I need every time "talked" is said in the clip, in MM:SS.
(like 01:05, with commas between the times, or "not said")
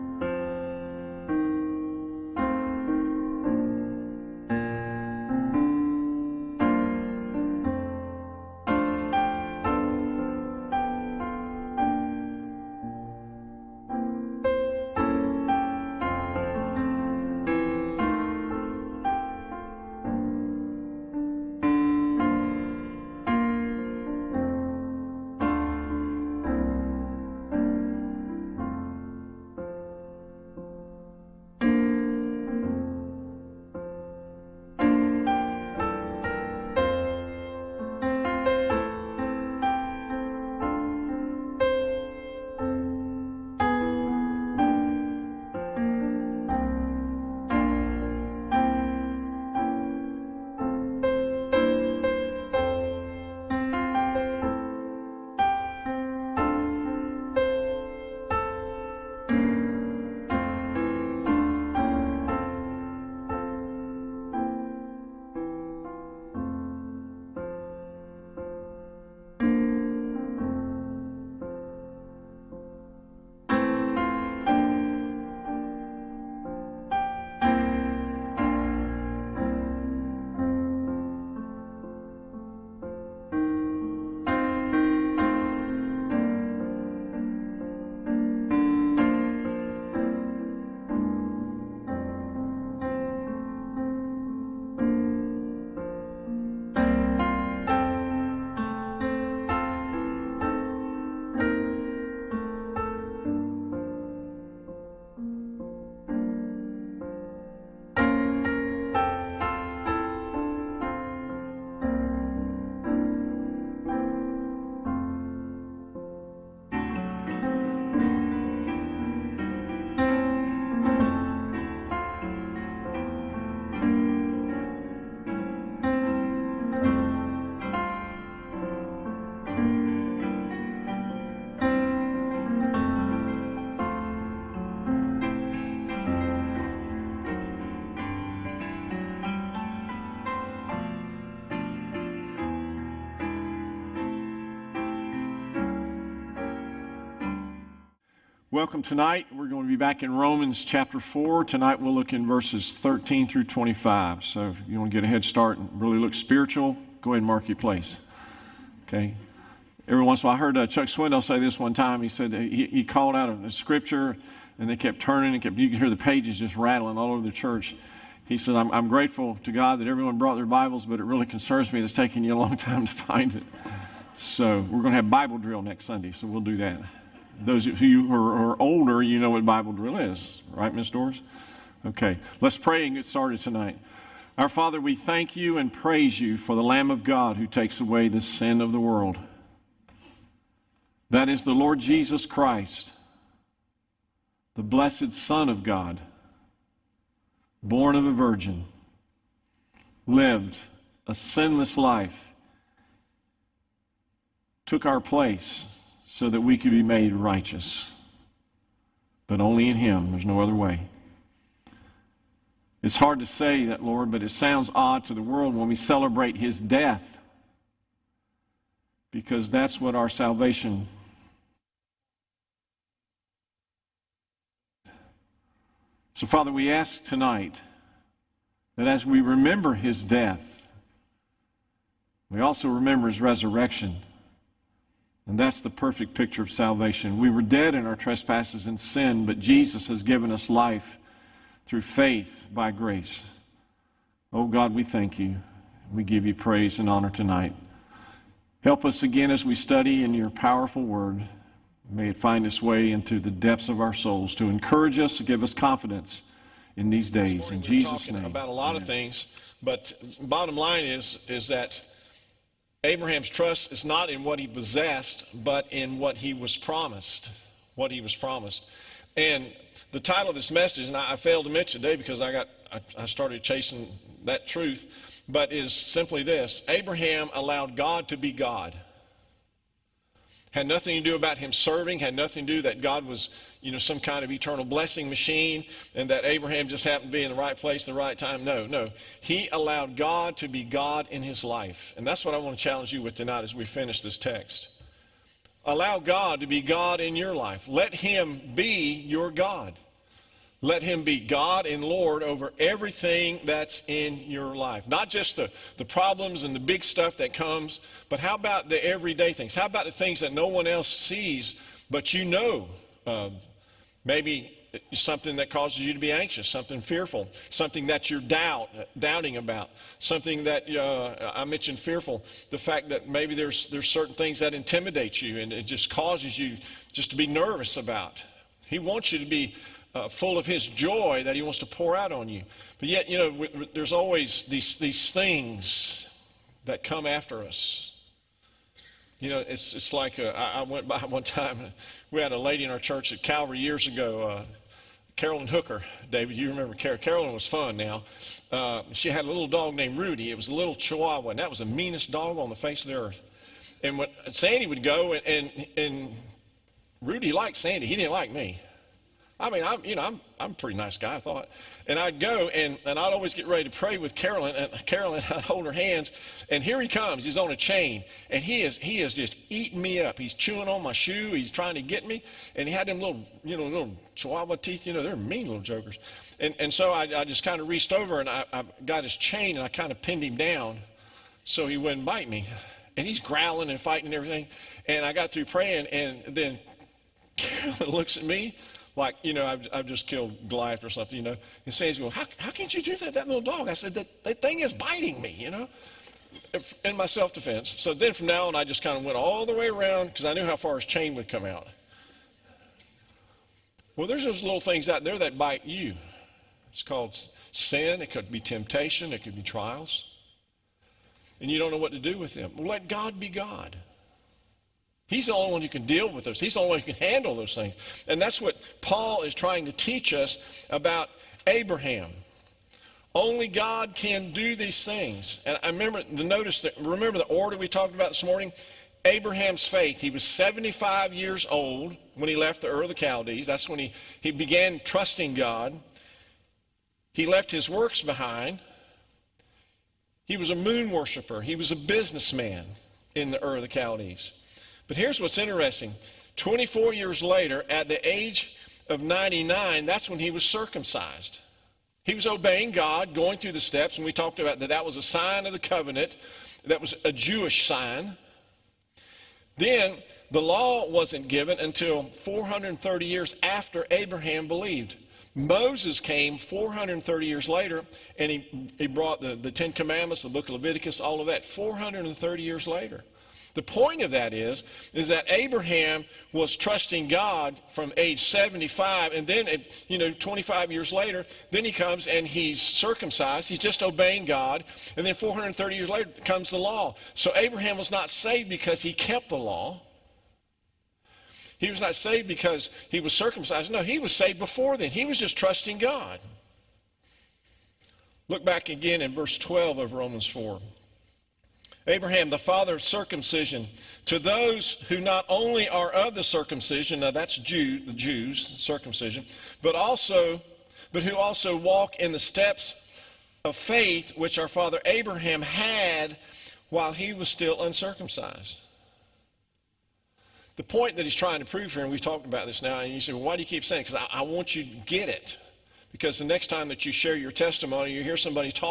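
07:07, 07:34, 08:41.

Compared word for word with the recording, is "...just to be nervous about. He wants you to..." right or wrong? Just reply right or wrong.
right.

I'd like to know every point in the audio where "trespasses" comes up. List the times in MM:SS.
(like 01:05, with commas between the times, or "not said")
03:57.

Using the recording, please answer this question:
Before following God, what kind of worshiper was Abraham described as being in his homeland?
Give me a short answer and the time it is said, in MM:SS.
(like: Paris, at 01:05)
moon worshiper, at 07:20.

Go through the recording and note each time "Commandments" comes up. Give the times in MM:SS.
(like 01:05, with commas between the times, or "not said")
07:49.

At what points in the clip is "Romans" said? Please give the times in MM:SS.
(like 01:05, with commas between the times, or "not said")
02:30, 08:19.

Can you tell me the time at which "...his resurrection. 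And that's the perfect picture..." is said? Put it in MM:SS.
03:53.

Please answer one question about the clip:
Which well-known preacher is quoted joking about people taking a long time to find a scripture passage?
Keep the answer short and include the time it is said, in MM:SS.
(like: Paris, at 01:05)
Chuck Swindoll, at 02:40.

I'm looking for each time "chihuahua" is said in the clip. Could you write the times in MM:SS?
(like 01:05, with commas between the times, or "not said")
05:50, 06:14.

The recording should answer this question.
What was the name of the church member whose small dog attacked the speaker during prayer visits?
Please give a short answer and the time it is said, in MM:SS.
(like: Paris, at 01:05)
Carolyn Hooker, at 05:45.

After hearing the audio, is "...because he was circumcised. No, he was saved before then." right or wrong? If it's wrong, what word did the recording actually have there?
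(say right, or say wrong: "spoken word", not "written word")
right.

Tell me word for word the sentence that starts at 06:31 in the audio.
And Sandy's going, how, how can you do that, that little dog?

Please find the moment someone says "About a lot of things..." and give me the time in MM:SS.
04:18.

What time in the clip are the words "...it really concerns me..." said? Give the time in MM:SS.
02:50.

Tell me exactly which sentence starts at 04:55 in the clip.
Allow God to be God in your life.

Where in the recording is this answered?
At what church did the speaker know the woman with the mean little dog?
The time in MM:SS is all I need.
05:43.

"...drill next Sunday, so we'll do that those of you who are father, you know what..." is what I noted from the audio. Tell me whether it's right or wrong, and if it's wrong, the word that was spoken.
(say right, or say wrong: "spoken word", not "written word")
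wrong: "older", not "father".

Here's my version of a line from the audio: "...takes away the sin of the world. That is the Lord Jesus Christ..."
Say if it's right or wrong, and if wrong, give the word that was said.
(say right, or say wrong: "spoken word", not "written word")
right.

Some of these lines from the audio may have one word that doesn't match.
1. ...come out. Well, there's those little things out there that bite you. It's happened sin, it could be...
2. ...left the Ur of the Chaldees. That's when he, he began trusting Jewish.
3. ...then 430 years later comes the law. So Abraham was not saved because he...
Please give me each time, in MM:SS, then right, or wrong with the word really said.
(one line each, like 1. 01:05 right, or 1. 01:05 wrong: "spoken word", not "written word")
1. 06:41 wrong: "called", not "happened"
2. 07:12 wrong: "God", not "Jewish"
3. 08:05 right.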